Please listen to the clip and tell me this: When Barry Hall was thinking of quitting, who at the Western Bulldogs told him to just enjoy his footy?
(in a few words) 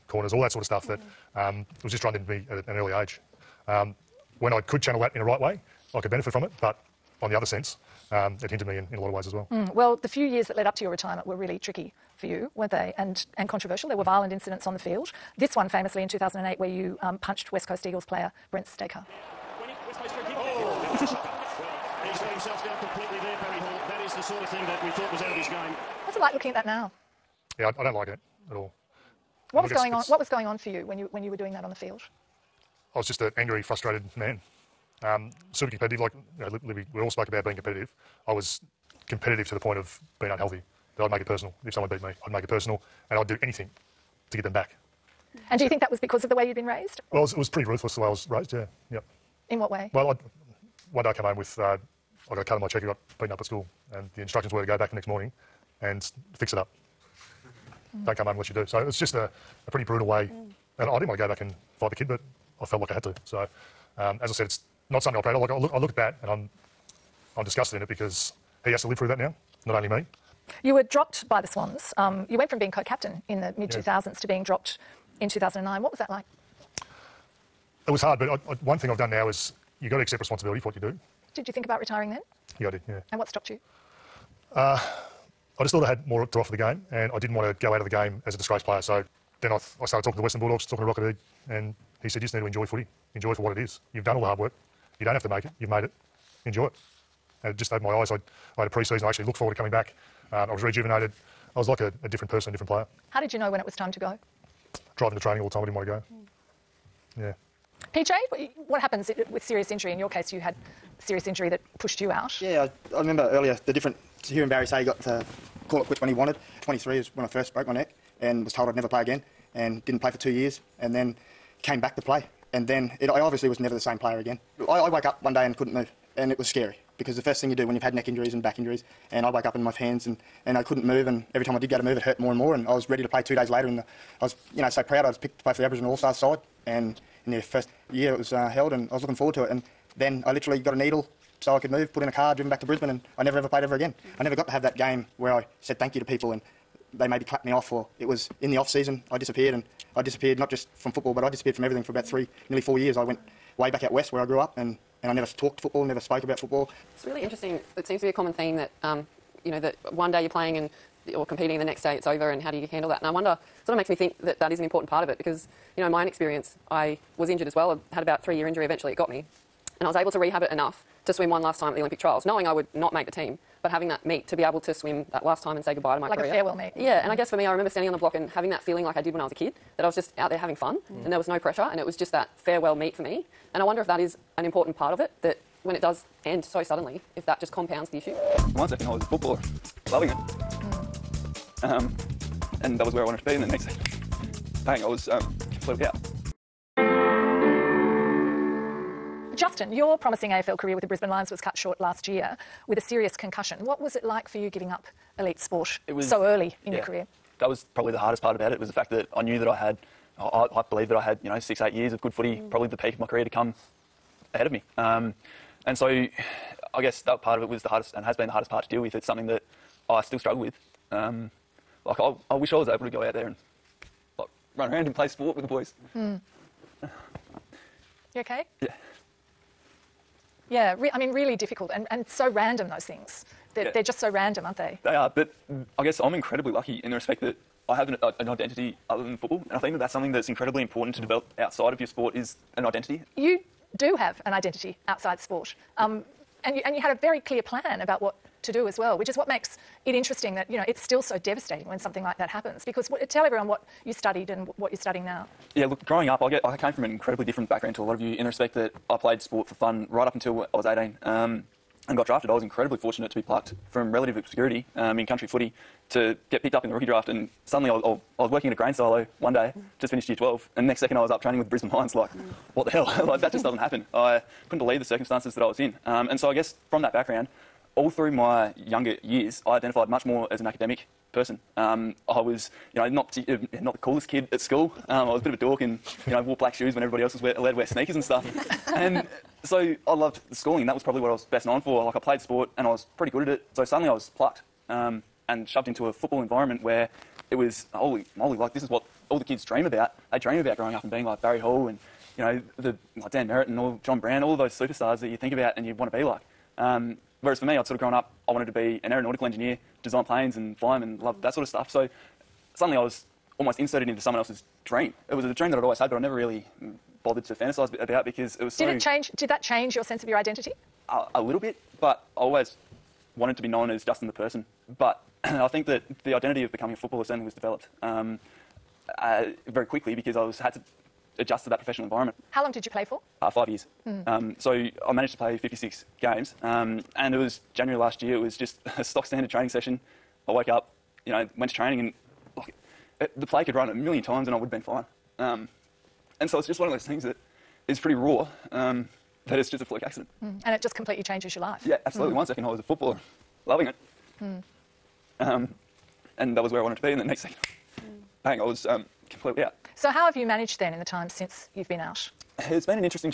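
Rocket.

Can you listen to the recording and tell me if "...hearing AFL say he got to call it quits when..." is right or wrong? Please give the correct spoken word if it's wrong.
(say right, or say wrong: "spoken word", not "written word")
wrong: "Barry", not "AFL".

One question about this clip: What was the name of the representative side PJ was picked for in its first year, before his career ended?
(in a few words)
Aboriginal All-Stars.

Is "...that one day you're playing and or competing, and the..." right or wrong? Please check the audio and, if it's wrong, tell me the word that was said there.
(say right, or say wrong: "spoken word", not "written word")
right.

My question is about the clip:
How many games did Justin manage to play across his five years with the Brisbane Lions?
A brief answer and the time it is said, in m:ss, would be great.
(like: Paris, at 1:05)
56, at 5:35.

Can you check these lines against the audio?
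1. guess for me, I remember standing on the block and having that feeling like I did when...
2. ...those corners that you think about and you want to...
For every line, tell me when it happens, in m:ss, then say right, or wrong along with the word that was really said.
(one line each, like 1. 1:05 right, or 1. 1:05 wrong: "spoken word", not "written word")
1. 2:57 right
2. 5:04 wrong: "superstars", not "corners".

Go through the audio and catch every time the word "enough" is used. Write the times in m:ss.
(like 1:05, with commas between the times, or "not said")
2:50.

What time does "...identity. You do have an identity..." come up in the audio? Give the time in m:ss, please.
4:02.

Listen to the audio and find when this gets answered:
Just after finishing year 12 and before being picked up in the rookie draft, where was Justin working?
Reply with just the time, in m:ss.
4:28.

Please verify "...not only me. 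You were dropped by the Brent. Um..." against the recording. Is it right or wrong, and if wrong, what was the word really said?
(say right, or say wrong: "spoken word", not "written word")
wrong: "Swans", not "Brent".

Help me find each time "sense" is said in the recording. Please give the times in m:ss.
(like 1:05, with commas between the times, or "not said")
0:07, 5:19.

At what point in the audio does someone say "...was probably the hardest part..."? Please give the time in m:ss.
3:27.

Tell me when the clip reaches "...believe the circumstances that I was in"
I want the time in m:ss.
4:34.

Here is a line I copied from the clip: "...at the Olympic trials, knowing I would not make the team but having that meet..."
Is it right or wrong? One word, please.
right.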